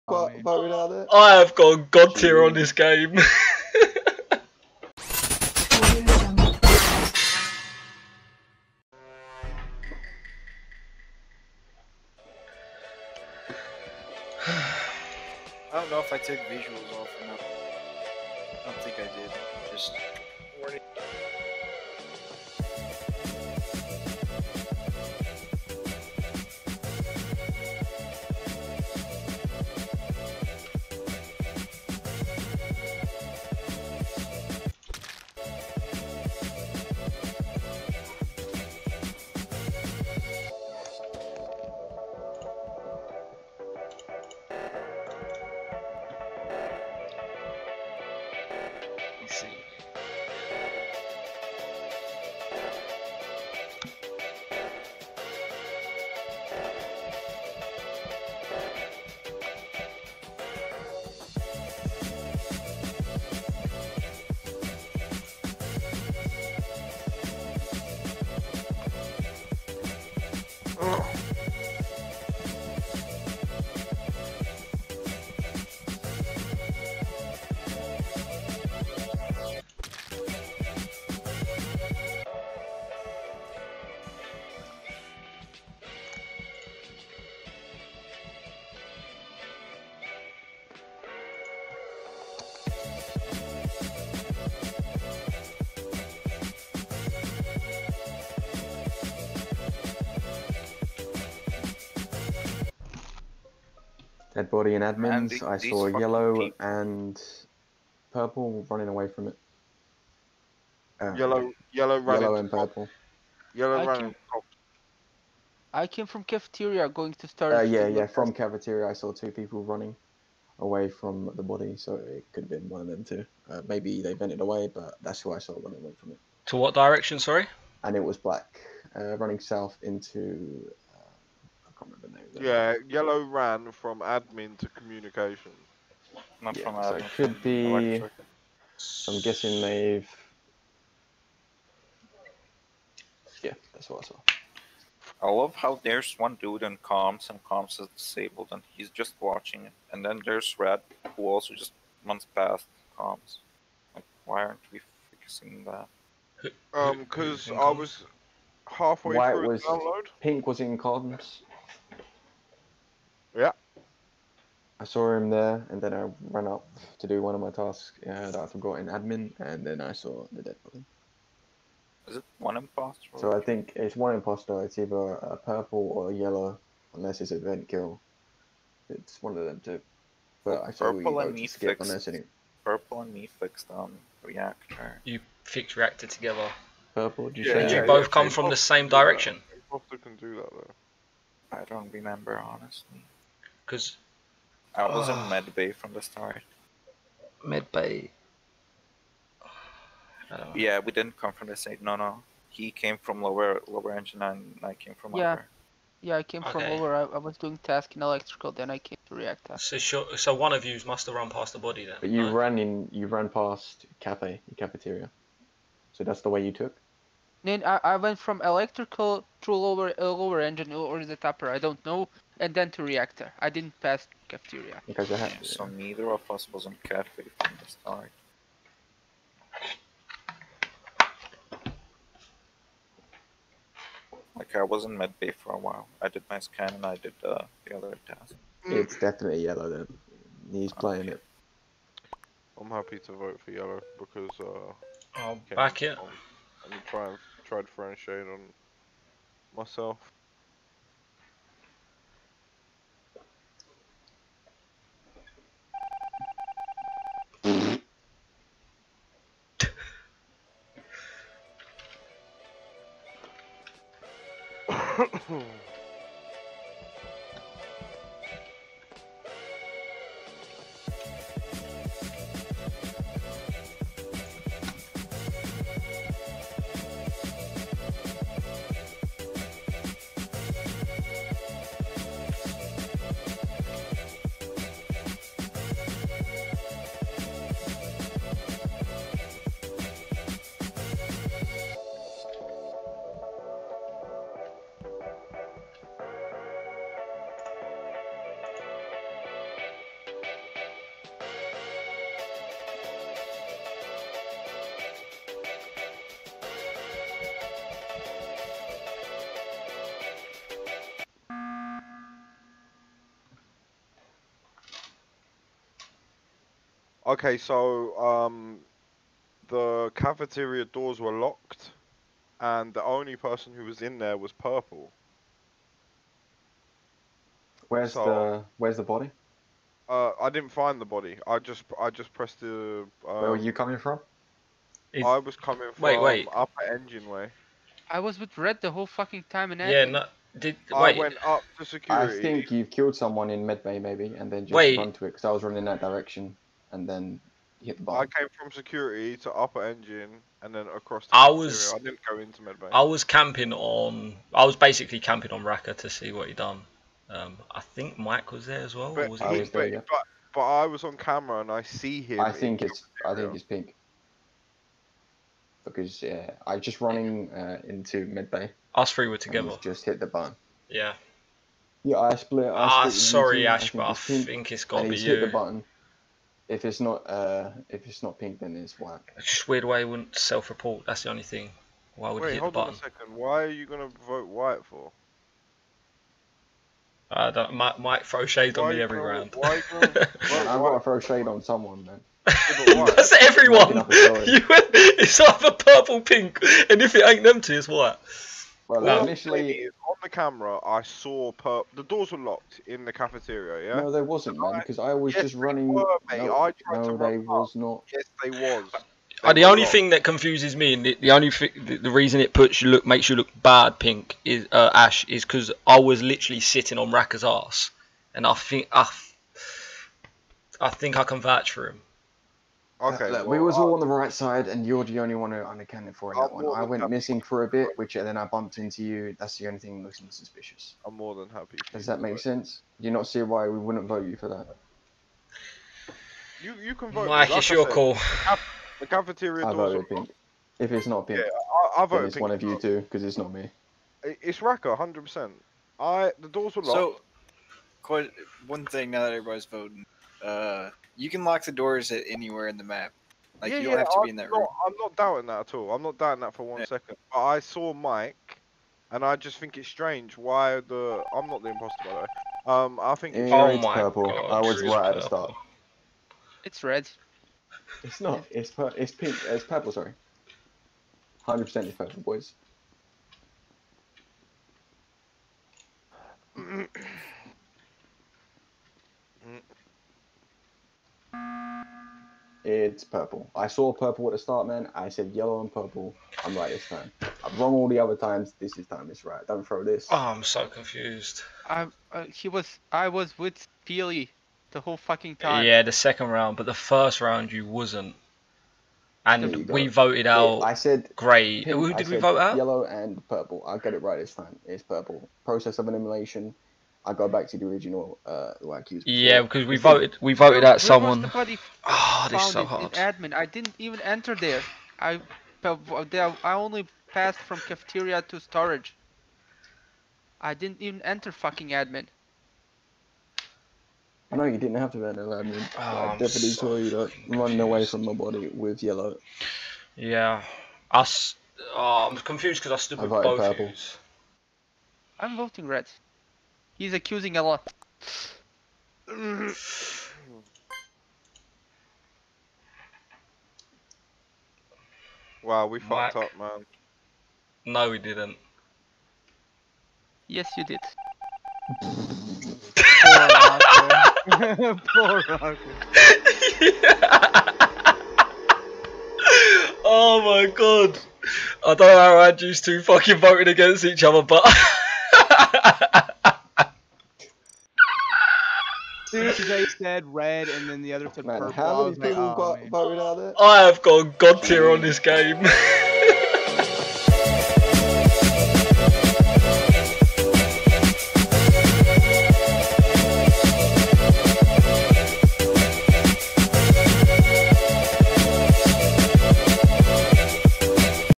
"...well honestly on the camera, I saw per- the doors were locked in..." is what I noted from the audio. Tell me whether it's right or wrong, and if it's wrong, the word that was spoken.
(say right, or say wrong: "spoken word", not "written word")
wrong: "initially", not "honestly".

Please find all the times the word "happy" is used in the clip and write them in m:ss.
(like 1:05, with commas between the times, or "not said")
4:02, 7:11.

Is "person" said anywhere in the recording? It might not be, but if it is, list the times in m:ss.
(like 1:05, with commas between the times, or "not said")
5:23.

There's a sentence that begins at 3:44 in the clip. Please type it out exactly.
Because I had, yeah, so neither of us was on cafe from the start.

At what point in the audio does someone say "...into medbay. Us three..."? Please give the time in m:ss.
6:07.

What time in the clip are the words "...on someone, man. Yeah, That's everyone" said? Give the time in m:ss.
6:31.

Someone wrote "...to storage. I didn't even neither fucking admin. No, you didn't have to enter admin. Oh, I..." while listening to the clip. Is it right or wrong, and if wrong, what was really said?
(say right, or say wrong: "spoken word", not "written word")
wrong: "enter", not "neither".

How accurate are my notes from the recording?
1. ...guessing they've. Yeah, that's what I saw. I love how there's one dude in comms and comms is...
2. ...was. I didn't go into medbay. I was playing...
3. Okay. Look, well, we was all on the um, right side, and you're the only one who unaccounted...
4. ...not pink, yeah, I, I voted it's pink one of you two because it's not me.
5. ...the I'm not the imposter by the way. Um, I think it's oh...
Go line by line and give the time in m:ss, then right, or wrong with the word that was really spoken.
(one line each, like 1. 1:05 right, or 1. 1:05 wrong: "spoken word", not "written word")
1. 2:19 right
2. 5:51 wrong: "camping", not "playing"
3. 7:02 right
4. 7:20 right
5. 7:40 right.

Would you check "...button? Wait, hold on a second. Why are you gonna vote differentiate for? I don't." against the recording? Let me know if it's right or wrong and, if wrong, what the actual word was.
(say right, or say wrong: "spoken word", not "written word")
wrong: "white", not "differentiate".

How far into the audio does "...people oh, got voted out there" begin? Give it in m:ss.
9:31.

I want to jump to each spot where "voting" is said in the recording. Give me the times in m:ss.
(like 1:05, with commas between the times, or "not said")
7:29, 8:55.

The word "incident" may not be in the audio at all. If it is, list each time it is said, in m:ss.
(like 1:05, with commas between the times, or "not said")
not said.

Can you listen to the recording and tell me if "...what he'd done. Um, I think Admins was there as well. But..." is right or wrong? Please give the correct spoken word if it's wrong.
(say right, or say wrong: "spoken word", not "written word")
wrong: "Mike", not "Admins".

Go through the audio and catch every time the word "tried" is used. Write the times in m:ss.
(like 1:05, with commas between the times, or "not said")
4:07, 6:46.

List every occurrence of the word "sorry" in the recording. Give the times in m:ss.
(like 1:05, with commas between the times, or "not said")
2:07, 6:12, 7:49.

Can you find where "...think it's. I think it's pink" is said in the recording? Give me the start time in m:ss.
6:02.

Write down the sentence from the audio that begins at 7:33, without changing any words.
Like yeah, you don't yeah, have to I'm be in that not, room.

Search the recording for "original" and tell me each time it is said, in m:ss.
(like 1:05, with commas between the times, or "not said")
8:27.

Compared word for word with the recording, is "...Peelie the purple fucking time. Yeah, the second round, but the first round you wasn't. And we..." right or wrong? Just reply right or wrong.
wrong.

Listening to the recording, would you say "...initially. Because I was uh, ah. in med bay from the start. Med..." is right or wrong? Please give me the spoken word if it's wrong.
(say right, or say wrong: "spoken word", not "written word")
wrong: "honestly", not "initially".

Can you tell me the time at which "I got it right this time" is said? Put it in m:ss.
8:23.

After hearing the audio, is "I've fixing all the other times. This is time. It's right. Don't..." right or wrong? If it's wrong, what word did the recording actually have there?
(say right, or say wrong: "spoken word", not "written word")
wrong: "wrong", not "fixing".